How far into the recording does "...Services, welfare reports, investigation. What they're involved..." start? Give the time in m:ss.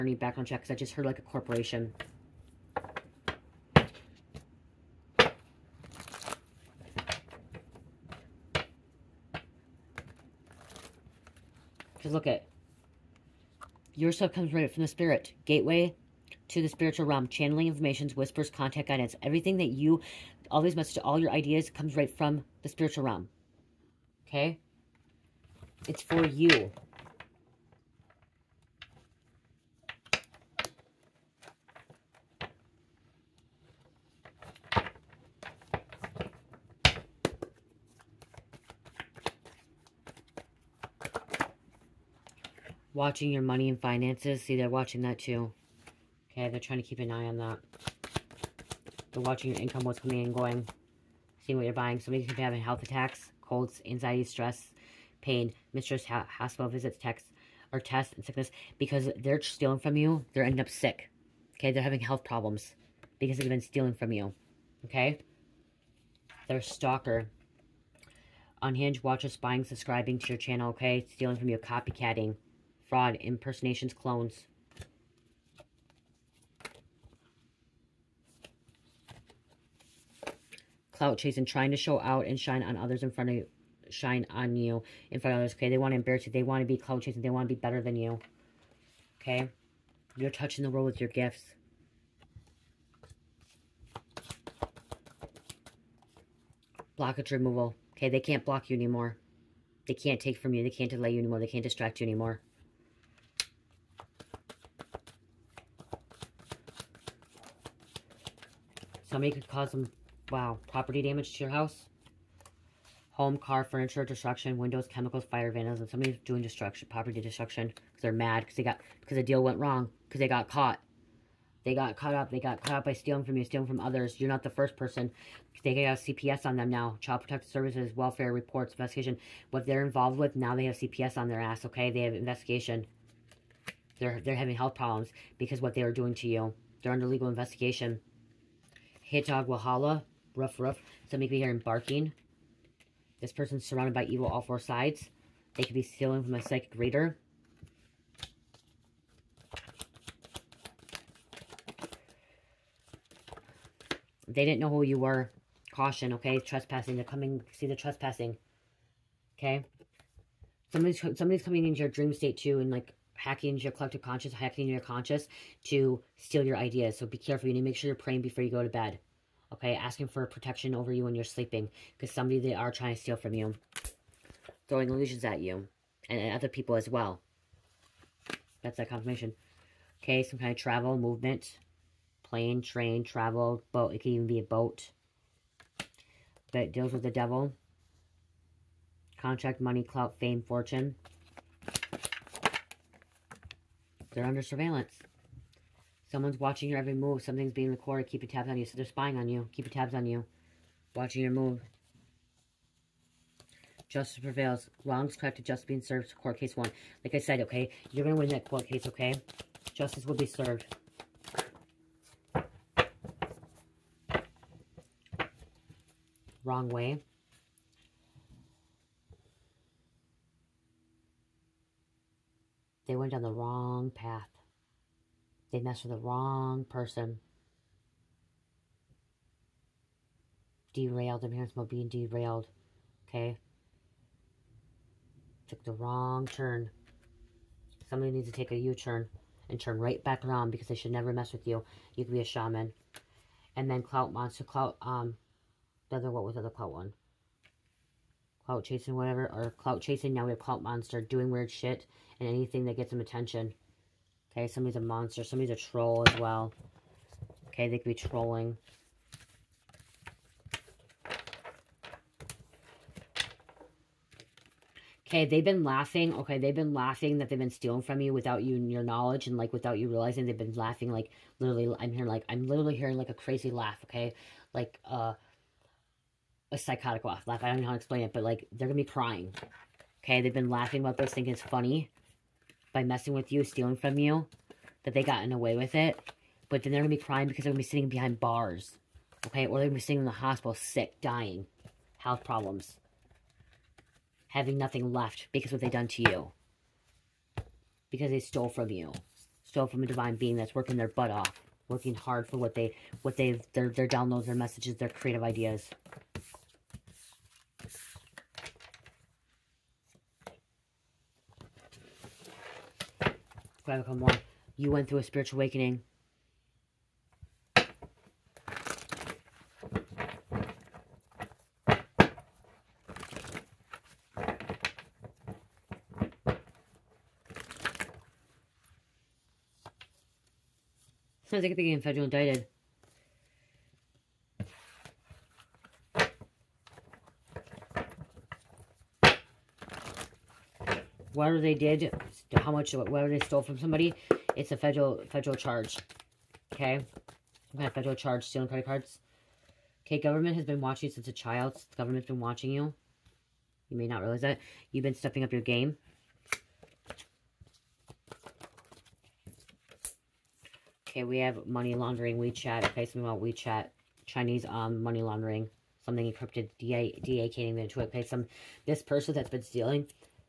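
2:07.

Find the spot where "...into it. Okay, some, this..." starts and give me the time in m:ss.
6:07.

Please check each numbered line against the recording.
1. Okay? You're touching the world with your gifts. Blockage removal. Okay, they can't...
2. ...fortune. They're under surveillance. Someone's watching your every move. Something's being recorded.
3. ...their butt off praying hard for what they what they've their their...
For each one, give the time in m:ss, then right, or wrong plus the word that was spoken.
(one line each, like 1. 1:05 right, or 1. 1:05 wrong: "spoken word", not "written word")
1. 1:29 right
2. 3:10 right
3. 5:00 wrong: "working", not "praying".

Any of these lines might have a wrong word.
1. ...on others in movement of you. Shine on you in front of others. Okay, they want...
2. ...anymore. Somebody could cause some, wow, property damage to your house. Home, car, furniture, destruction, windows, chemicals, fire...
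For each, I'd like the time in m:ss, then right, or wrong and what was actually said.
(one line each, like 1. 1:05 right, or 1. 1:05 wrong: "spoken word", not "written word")
1. 1:22 wrong: "front", not "movement"
2. 1:42 right.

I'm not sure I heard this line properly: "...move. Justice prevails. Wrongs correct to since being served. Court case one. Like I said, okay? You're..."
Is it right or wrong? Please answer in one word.
wrong.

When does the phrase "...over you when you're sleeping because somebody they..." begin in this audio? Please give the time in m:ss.
2:50.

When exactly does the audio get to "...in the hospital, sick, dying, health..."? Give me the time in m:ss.
4:50.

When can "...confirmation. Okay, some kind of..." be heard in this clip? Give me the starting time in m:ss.
2:58.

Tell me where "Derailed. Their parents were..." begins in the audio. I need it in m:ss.
3:50.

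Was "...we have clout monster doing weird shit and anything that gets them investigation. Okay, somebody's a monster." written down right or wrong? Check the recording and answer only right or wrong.
wrong.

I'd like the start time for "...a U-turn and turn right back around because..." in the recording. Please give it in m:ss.
3:58.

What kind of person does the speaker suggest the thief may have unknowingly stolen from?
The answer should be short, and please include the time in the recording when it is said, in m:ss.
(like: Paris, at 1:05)
a psychic reader, at 2:26.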